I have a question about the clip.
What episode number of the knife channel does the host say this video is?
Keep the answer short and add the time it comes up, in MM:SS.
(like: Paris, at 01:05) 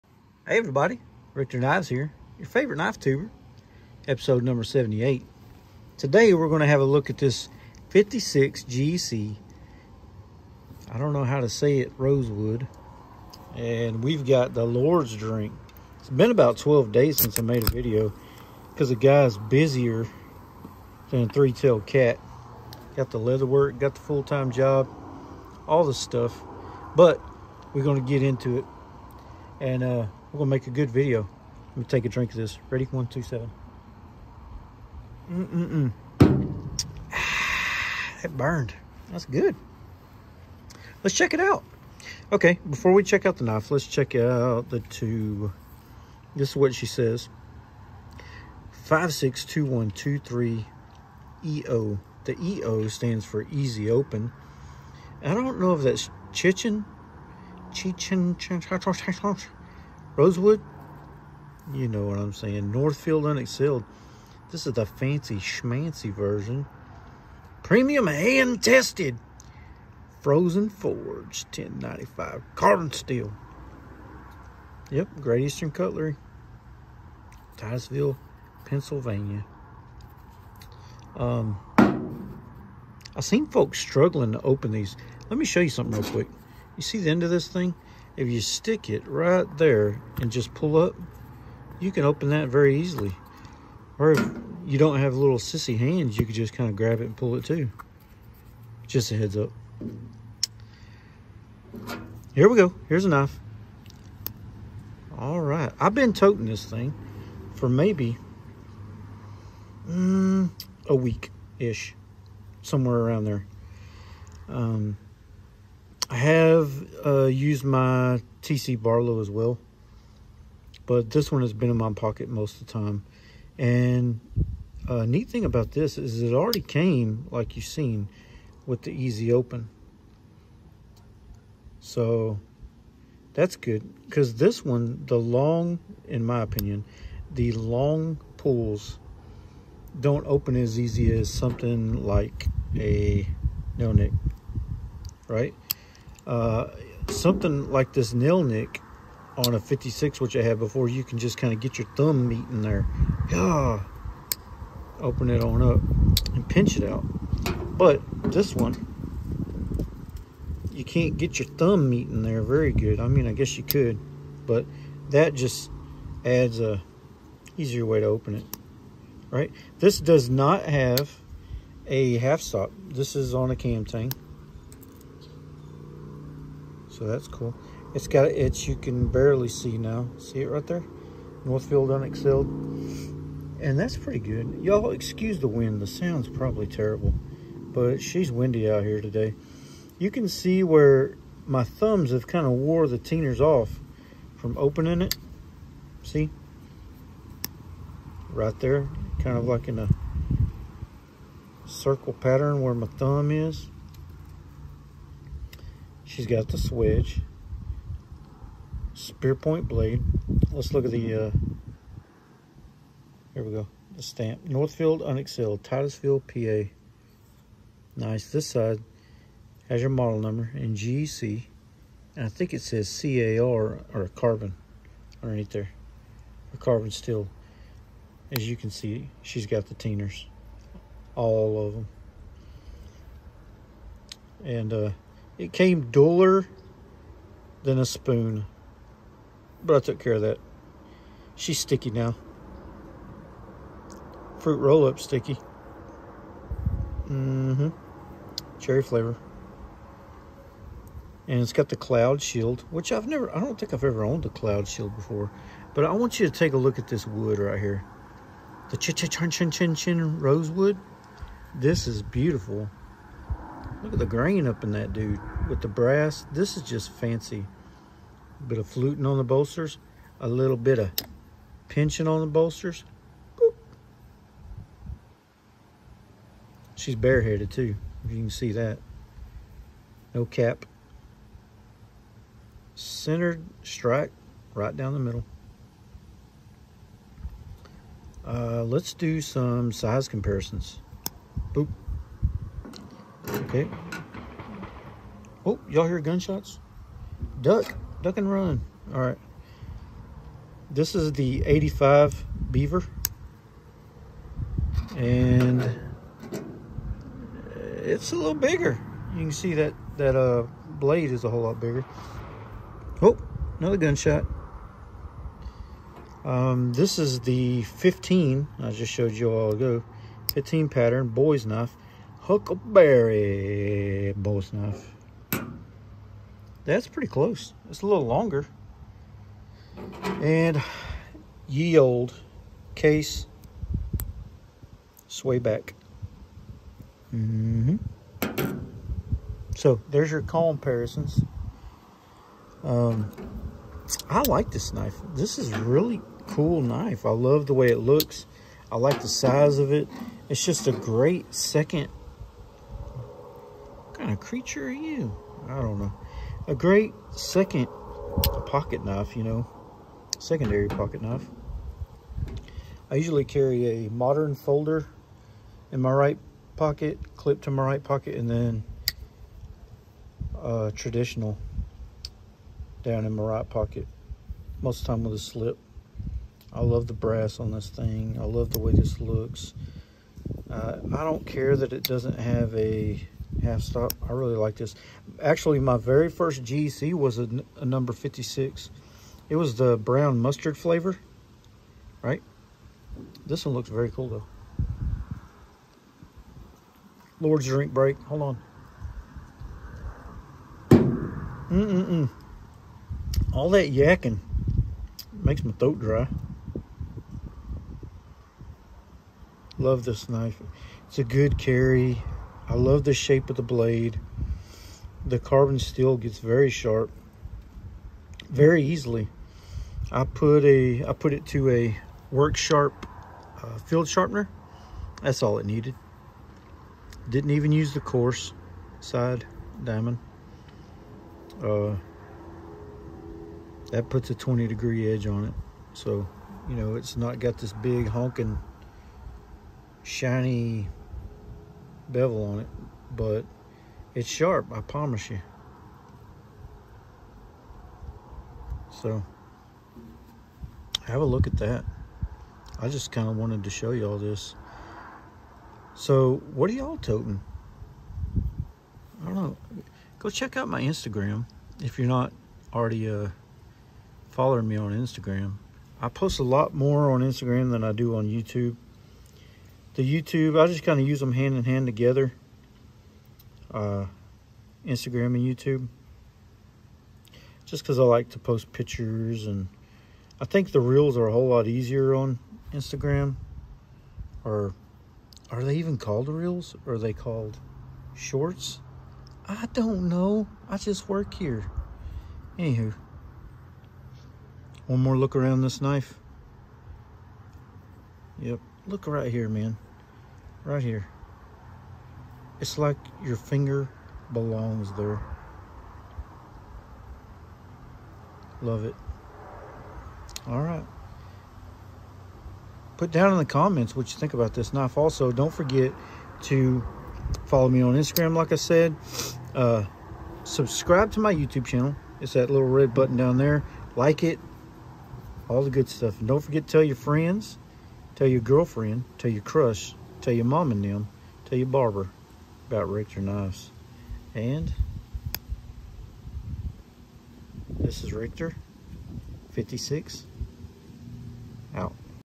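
78, at 00:04.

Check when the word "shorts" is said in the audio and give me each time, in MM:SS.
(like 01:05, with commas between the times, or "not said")
08:07.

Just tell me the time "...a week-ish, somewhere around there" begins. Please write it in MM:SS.
01:50.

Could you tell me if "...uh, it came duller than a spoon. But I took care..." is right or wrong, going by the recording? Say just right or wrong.
right.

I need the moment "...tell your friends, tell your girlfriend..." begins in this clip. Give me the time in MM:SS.
08:46.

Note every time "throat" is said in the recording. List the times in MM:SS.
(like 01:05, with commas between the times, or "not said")
06:45.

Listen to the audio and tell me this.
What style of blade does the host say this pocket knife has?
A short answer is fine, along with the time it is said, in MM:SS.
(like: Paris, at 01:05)
spear point, at 03:28.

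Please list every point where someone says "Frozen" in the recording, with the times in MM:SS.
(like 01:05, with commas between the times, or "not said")
01:10.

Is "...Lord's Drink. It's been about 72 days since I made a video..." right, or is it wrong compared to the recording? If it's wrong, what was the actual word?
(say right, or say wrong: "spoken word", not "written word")
wrong: "12", not "72".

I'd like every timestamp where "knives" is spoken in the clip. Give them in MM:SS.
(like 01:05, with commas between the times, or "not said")
00:01, 08:52.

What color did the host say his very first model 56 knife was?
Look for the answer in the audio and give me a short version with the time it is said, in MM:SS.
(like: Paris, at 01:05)
brown mustard, at 06:29.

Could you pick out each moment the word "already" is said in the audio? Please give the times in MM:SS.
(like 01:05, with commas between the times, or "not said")
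02:06, 07:42.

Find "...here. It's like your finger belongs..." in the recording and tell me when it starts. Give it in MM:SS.
08:20.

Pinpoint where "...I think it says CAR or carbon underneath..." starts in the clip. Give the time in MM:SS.
03:42.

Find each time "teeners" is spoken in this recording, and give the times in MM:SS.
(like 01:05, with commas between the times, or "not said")
03:12, 03:49.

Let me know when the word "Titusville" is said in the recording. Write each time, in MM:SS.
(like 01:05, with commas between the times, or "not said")
01:17, 03:35.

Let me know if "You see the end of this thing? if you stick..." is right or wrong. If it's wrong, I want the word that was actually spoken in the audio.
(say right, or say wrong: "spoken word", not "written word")
right.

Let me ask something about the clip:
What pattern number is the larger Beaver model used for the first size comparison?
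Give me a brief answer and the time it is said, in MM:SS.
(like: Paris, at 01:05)
85, at 05:01.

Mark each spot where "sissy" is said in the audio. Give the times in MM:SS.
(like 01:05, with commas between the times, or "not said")
01:35.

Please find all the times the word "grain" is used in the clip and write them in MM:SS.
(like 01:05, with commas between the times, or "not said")
04:24.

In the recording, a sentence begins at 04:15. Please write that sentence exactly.
But I want you to take a look at this wood right here.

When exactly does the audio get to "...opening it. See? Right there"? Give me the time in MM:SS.
03:14.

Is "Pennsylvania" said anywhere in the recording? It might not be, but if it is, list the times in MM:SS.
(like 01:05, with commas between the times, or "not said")
01:18.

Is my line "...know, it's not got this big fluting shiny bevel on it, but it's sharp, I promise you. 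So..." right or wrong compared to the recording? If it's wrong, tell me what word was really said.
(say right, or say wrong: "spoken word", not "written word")
wrong: "honking", not "fluting".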